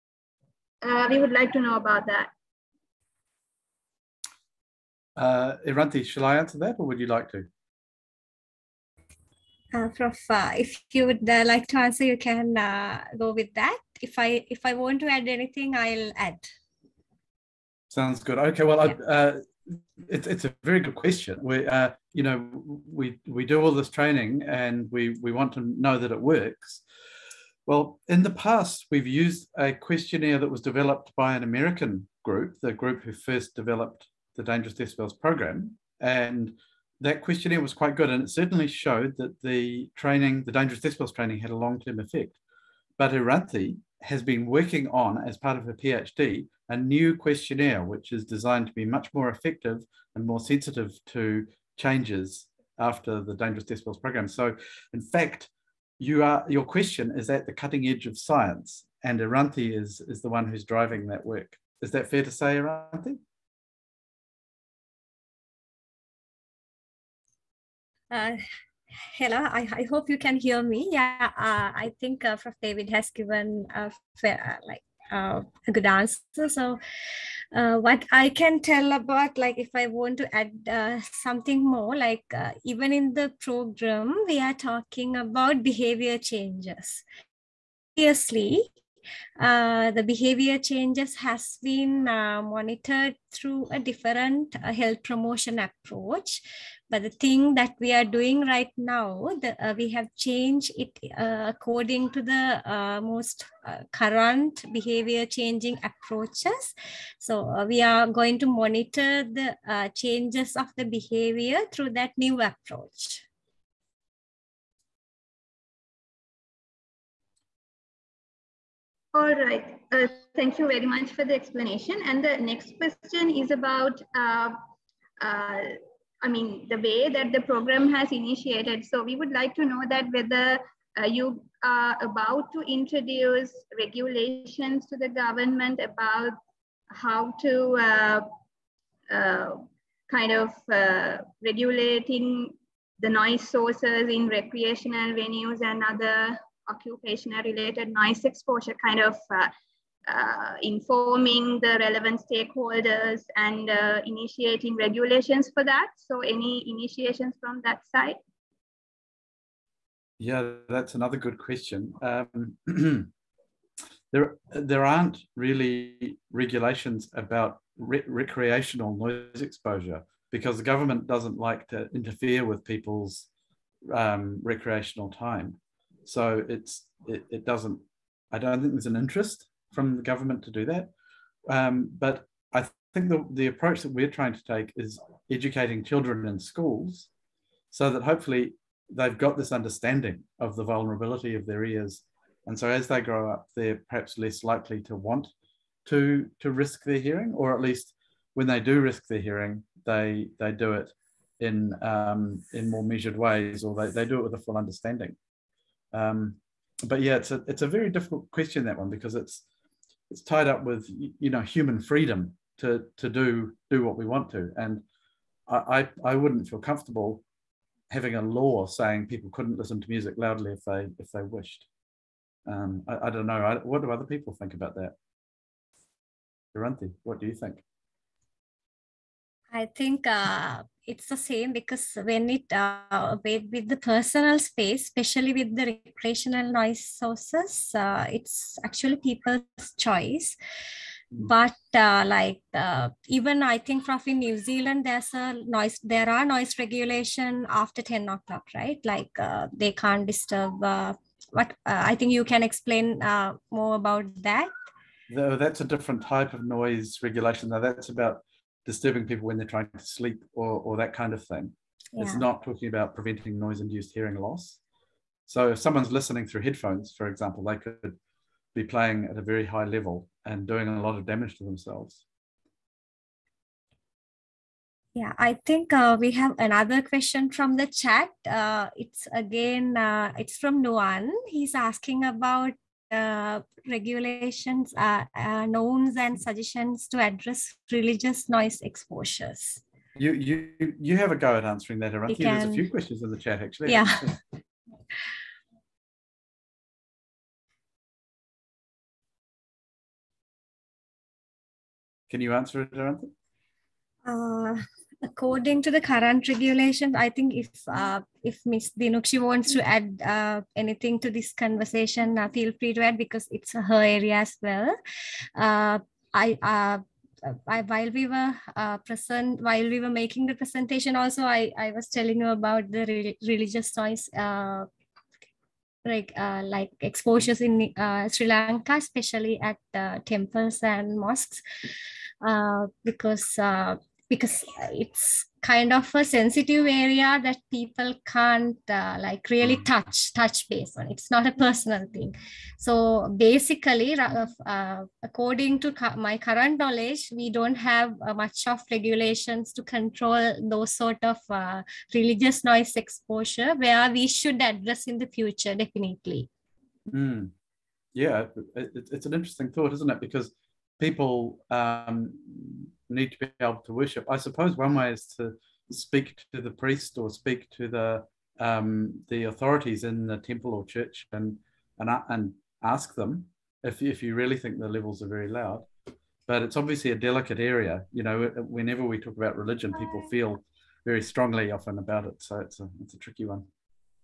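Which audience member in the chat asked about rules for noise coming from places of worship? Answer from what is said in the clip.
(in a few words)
Noan.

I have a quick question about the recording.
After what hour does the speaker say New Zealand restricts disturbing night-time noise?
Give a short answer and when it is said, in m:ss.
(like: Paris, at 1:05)
10 o'clock, at 4:07.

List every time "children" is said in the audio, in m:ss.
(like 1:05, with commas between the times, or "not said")
3:05.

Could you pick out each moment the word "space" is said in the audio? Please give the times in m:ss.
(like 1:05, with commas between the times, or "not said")
3:54.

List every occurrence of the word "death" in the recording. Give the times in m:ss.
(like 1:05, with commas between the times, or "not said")
0:34, 0:40.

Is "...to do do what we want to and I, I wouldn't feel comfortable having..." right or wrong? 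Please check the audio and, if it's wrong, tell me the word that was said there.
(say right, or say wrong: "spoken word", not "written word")
right.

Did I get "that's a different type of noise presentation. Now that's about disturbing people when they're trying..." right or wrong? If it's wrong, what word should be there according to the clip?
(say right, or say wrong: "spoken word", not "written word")
wrong: "regulation", not "presentation".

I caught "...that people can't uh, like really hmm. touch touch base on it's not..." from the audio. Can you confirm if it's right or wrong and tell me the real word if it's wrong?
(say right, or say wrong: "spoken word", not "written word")
right.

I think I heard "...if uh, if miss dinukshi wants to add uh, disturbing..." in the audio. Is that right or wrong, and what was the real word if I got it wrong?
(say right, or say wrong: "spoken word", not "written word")
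wrong: "anything", not "disturbing".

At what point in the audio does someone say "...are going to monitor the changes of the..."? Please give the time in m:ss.
1:47.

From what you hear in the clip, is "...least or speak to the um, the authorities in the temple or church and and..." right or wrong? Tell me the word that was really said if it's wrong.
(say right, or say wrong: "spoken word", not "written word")
wrong: "priest", not "least".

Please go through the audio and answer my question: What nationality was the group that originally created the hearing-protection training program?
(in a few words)
American.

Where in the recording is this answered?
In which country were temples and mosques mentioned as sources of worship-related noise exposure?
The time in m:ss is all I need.
5:28.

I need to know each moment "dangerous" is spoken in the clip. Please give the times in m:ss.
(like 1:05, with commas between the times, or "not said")
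0:34, 0:40, 0:53.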